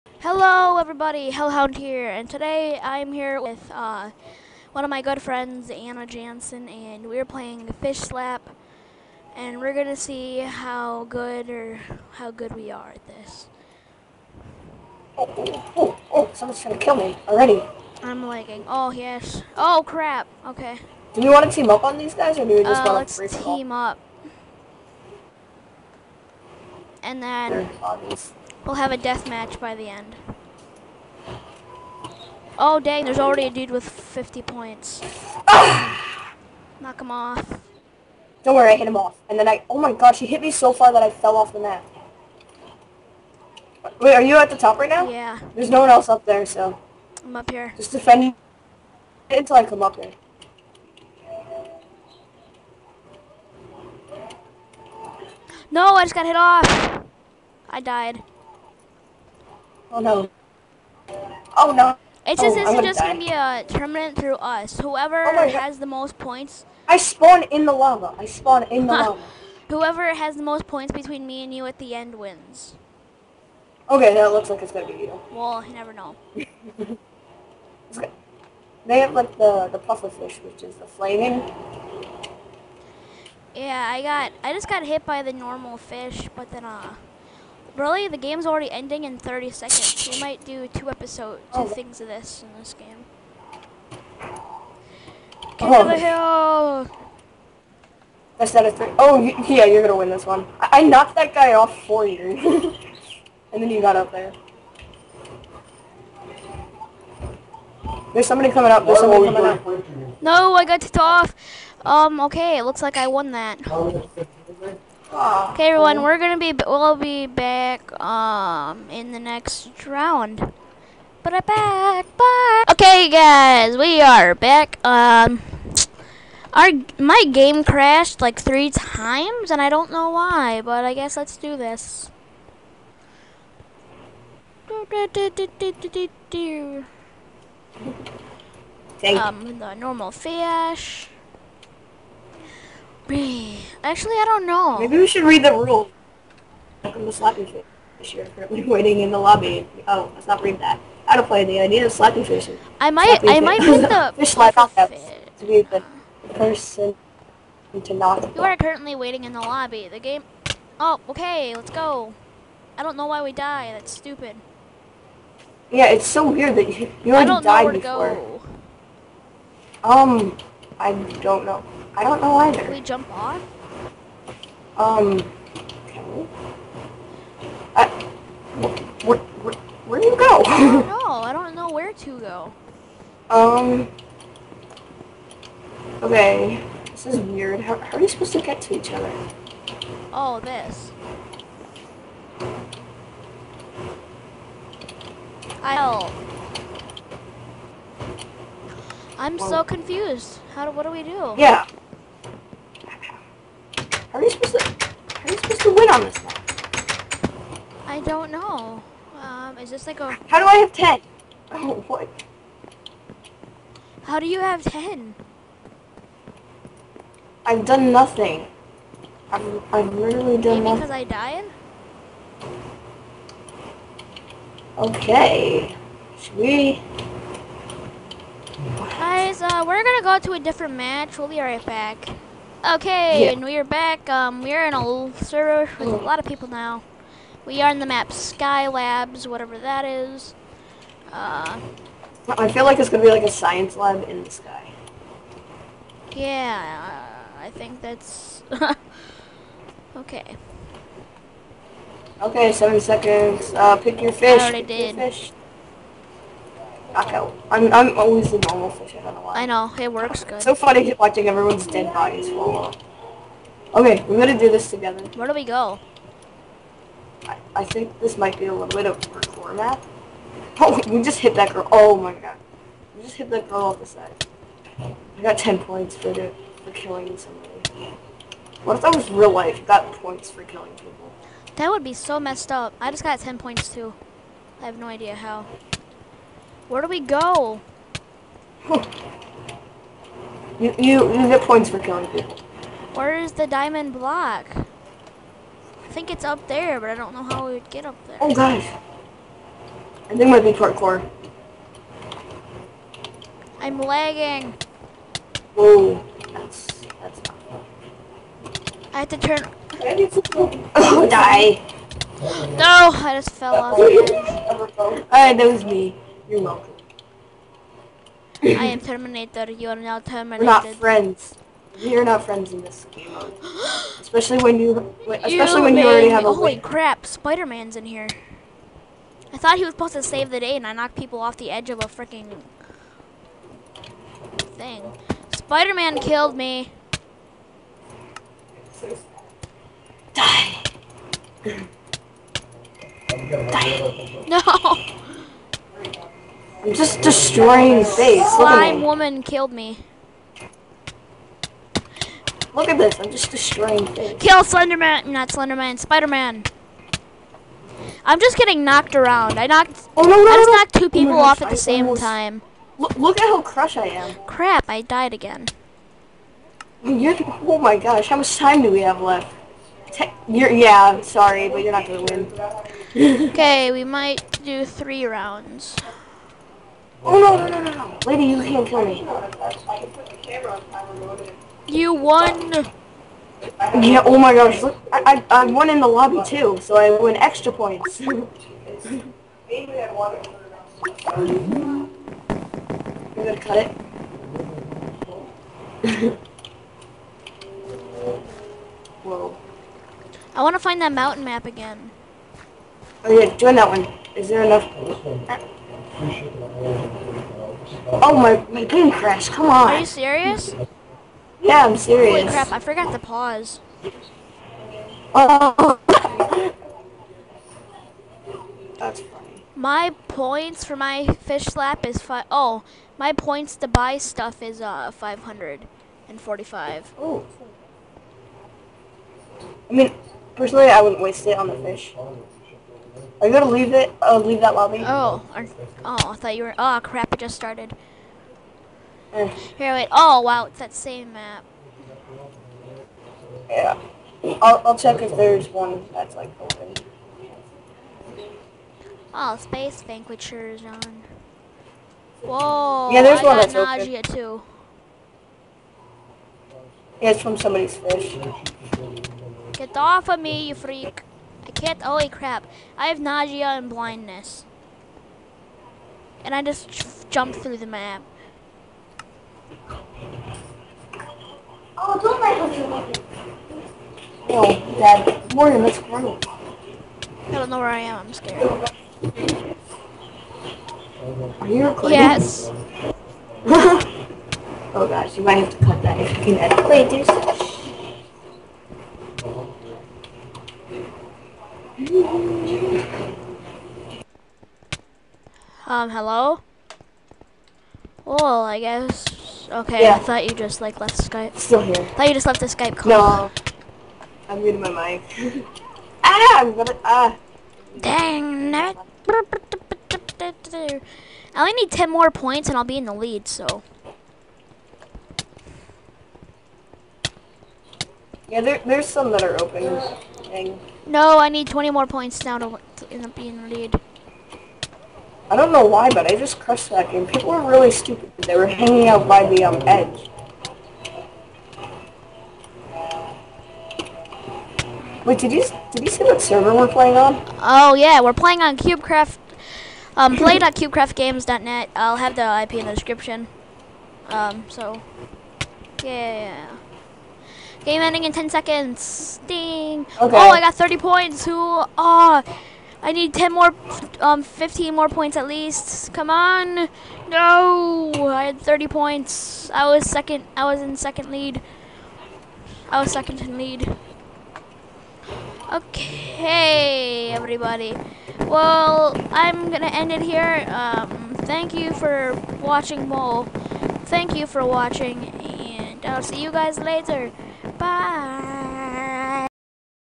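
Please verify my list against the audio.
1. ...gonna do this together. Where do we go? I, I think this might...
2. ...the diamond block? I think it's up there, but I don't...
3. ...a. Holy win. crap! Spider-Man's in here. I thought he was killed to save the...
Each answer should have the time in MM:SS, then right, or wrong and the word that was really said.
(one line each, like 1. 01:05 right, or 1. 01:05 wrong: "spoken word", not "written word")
1. 04:24 right
2. 04:53 right
3. 05:26 wrong: "supposed", not "killed".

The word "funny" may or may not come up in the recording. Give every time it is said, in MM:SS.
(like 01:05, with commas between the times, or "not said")
04:20, 06:59.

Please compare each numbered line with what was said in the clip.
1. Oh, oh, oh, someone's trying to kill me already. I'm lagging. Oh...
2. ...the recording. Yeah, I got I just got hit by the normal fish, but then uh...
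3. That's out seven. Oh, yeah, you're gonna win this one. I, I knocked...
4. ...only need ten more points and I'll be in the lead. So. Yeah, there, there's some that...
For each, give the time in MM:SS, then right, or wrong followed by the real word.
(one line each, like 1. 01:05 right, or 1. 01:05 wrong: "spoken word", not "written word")
1. 00:15 right
2. 01:20 wrong: "flaming", not "recording"
3. 01:38 wrong: "three", not "seven"
4. 08:31 right.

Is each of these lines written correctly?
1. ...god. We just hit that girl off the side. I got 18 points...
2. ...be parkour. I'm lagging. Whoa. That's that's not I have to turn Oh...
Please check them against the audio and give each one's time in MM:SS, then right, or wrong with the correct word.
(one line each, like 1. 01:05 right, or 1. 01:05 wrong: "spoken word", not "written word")
1. 04:32 wrong: "10", not "18"
2. 05:00 right.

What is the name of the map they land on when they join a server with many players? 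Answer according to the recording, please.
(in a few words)
Skylabs.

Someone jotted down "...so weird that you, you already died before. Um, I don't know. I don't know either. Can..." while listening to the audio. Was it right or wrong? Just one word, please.
right.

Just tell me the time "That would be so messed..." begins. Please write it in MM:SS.
04:41.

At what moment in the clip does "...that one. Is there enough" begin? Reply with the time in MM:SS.
06:43.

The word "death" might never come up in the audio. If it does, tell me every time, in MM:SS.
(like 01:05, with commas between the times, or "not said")
00:28.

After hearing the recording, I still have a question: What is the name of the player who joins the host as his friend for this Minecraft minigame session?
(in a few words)
Anna Janson.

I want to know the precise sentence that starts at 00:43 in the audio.
Wait, are you at the top right now?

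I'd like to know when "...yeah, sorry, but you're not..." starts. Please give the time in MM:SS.
06:10.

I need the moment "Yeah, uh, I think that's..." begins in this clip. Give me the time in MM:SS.
04:06.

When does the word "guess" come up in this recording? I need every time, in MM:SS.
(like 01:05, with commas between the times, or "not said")
02:10, 08:18.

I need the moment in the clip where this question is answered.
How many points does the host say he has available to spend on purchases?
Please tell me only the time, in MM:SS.
07:04.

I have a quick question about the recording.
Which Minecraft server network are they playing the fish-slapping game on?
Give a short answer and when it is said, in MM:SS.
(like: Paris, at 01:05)
CubeCraft, at 08:58.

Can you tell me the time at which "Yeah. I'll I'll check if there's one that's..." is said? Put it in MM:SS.
07:23.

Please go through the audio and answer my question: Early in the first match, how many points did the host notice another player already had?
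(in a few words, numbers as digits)
50.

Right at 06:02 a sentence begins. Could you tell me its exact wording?
Look, look at how crushed I am.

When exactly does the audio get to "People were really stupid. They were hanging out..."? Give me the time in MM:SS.
08:47.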